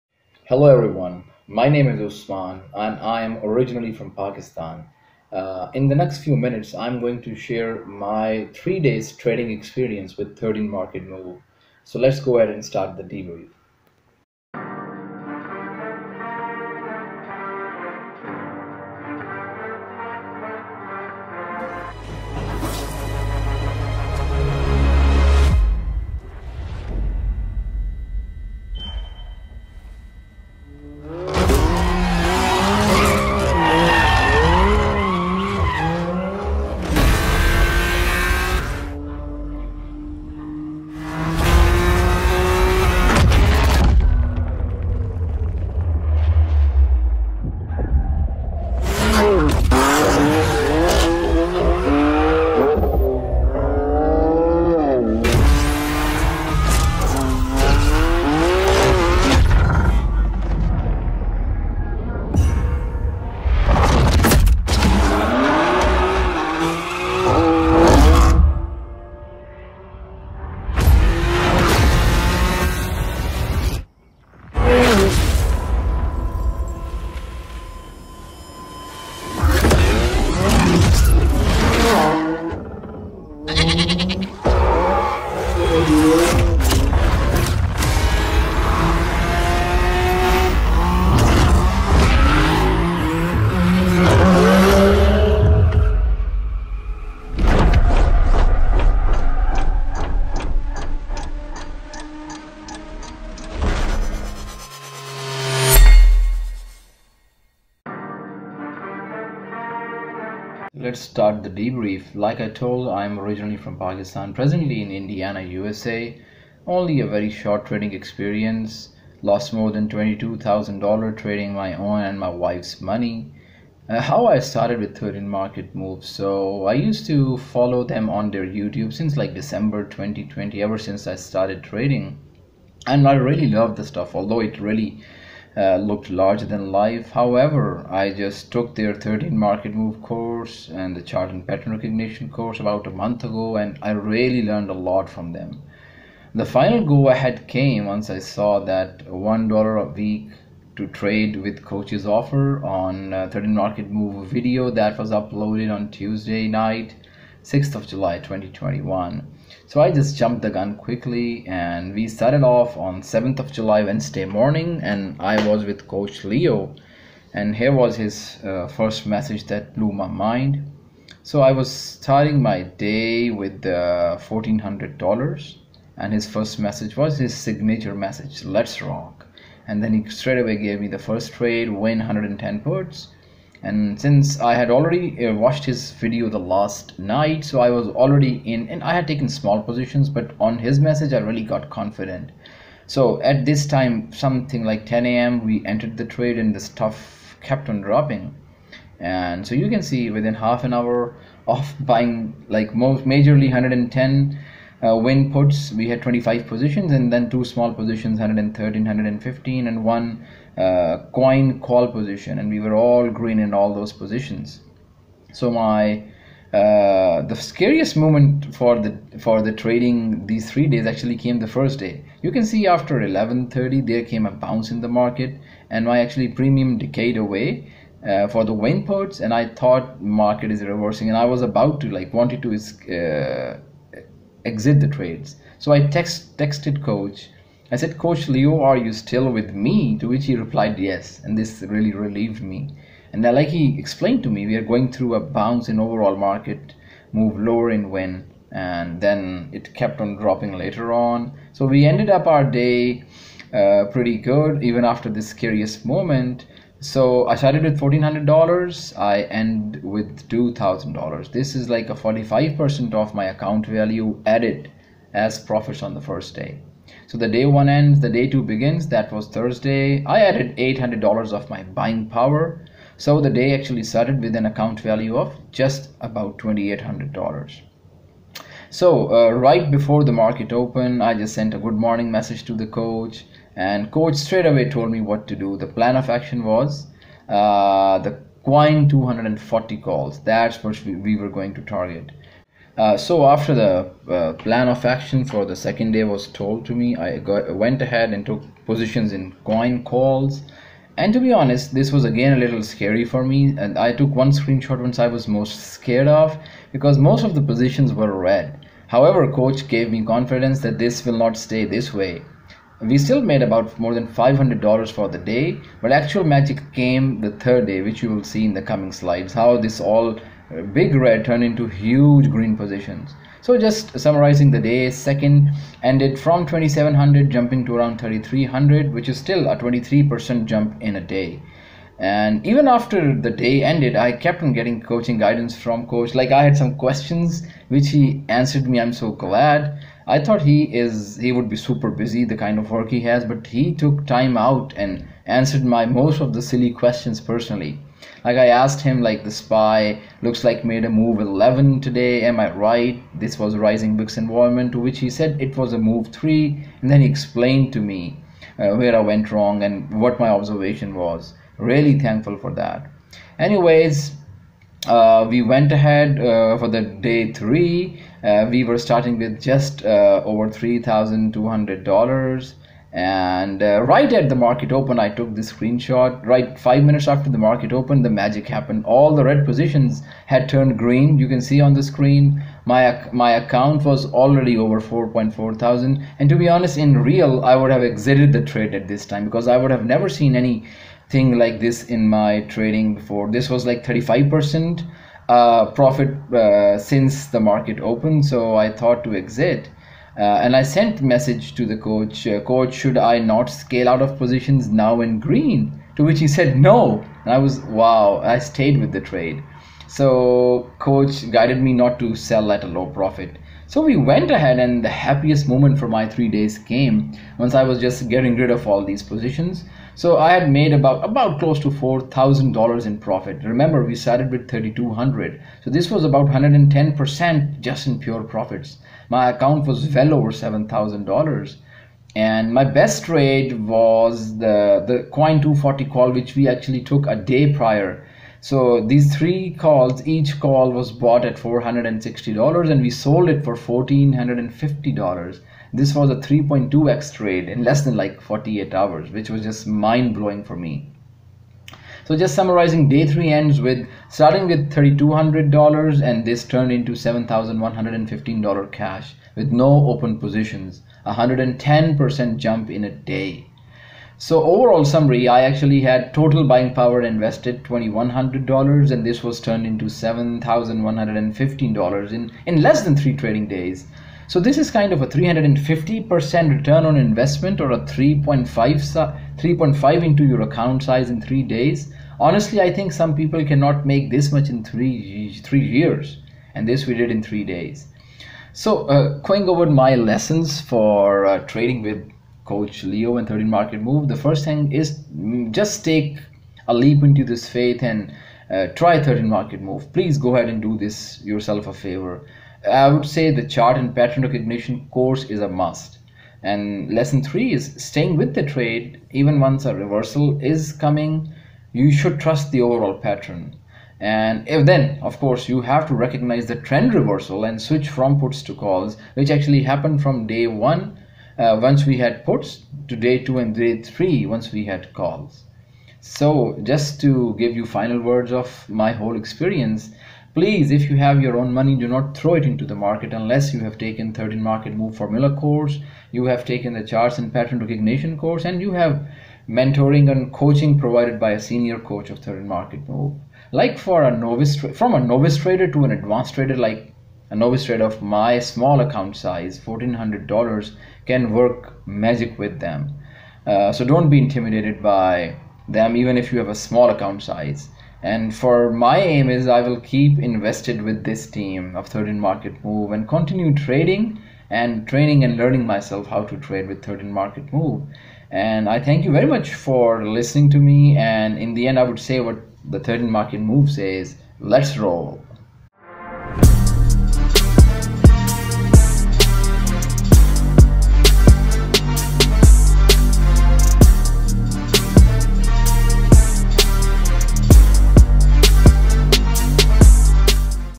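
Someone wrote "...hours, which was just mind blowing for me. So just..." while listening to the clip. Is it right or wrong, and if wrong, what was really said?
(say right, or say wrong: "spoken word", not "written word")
right.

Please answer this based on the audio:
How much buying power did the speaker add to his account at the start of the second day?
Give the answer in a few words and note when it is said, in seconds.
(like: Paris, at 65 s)
$800, at 270 s.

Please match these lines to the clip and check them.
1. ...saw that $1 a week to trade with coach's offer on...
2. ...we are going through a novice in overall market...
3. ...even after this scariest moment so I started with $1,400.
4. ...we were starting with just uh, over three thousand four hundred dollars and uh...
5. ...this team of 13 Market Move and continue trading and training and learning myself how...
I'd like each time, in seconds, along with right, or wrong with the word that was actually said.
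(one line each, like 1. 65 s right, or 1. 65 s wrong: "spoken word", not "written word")
1. 148 s right
2. 244 s wrong: "bounce", not "novice"
3. 254 s right
4. 368 s wrong: "two", not "four"
5. 561 s right.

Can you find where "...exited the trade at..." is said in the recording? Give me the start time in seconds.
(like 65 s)
387 s.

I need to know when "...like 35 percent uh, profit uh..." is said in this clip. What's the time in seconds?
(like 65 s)
393 s.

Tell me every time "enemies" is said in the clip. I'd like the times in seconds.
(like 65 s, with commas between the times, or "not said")
not said.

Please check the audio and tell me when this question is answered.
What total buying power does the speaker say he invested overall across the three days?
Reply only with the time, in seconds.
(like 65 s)
467 s.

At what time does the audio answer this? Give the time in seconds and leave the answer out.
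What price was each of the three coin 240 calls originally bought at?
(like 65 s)
441 s.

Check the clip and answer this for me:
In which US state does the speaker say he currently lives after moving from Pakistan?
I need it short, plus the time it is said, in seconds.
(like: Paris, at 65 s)
Indiana, at 114 s.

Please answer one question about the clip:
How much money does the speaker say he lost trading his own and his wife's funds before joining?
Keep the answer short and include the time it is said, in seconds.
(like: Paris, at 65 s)
$22,000, at 119 s.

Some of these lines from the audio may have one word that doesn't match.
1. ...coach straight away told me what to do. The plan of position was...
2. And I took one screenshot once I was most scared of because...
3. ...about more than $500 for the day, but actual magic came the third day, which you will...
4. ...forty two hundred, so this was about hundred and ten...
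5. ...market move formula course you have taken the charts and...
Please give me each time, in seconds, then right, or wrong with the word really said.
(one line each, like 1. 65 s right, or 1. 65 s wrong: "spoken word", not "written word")
1. 283 s wrong: "action", not "position"
2. 303 s right
3. 313 s right
4. 424 s wrong: "thirty", not "forty"
5. 534 s right.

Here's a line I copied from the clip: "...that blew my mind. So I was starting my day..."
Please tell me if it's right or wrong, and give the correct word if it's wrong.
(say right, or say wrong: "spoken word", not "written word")
right.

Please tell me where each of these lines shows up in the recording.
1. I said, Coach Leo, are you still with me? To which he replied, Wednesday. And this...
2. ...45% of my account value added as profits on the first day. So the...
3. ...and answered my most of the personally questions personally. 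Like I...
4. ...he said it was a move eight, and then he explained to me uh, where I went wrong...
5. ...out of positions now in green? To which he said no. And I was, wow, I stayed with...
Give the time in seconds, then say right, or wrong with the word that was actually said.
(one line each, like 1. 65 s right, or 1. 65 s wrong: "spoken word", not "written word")
1. 237 s wrong: "Yes", not "Wednesday"
2. 261 s right
3. 344 s wrong: "silly", not "personally"
4. 354 s wrong: "three", not "eight"
5. 403 s right.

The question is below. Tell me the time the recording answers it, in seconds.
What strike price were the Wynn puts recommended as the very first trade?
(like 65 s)
181 s.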